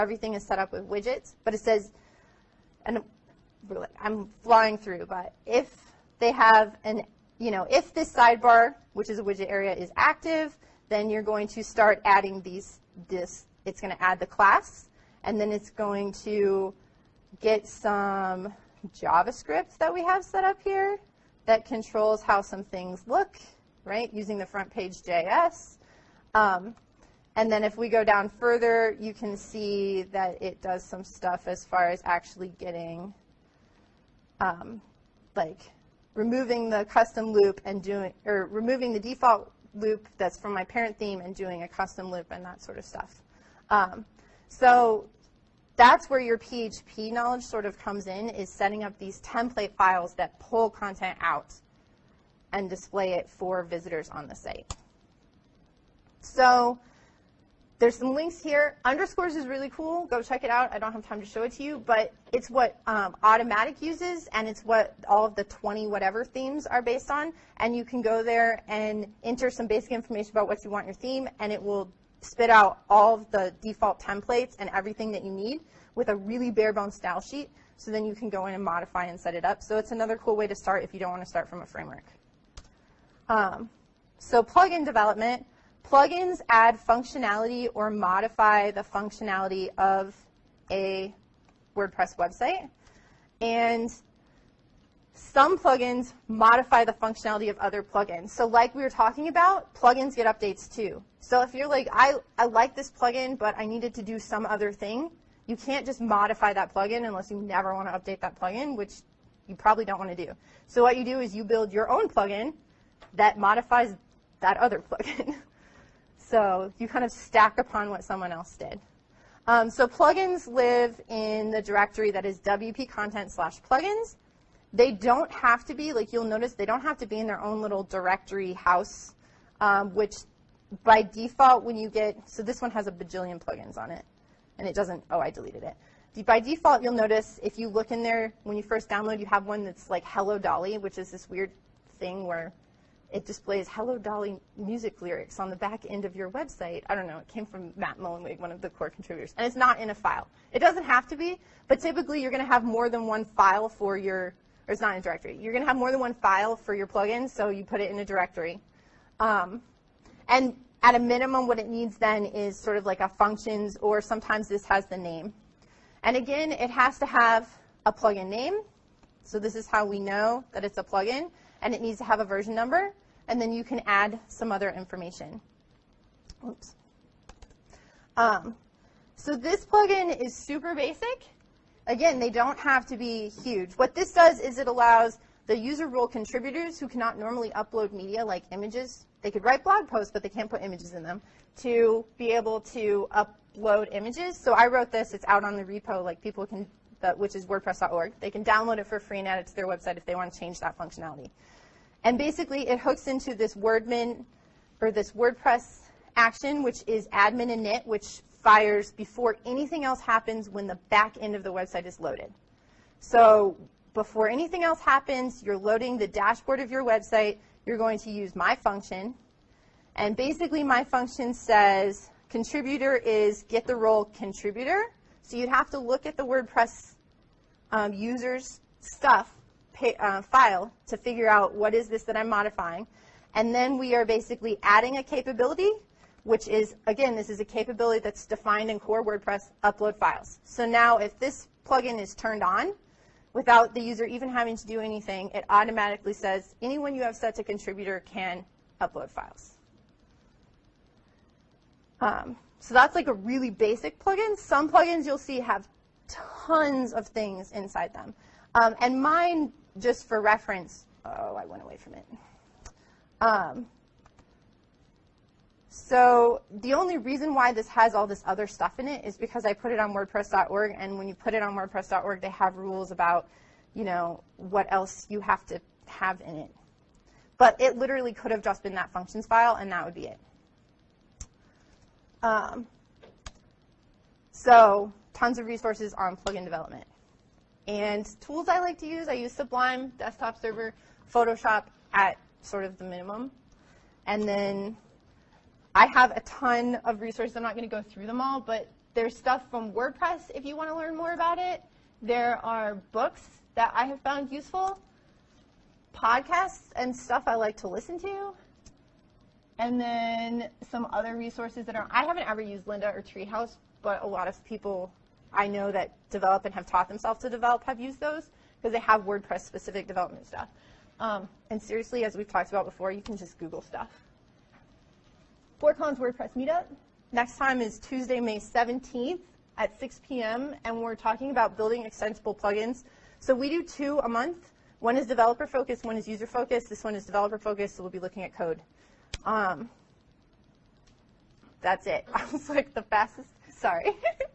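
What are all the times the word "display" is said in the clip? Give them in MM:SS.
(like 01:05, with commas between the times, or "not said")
00:52, 02:23.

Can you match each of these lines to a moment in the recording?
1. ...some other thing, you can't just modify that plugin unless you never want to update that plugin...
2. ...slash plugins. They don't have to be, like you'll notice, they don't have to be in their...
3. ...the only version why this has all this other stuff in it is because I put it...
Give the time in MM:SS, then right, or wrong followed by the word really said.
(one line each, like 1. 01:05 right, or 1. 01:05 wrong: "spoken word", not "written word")
1. 01:44 right
2. 02:03 right
3. 04:26 wrong: "reason", not "version".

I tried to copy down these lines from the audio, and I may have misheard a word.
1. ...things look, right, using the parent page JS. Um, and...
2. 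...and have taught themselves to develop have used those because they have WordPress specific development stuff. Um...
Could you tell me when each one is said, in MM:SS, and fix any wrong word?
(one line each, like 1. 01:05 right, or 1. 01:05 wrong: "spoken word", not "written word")
1. 00:22 wrong: "front", not "parent"
2. 05:16 right.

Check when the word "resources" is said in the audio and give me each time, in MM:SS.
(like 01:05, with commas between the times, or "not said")
04:45, 04:56, 05:11.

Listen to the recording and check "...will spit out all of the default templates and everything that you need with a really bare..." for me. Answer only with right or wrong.
right.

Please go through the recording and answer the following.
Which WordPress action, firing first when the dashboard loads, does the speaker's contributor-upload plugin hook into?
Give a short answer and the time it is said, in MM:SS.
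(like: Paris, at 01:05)
admin init, at 03:27.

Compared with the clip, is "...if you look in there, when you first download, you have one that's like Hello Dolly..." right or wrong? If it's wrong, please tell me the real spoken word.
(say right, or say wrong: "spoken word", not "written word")
right.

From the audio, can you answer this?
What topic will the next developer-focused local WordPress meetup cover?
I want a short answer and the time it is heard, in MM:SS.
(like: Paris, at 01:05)
building extensible plugins, at 05:31.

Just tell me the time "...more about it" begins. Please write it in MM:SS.
05:00.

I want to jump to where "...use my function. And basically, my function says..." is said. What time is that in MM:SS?
03:38.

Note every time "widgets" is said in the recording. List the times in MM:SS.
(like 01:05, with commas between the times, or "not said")
00:00, 00:09.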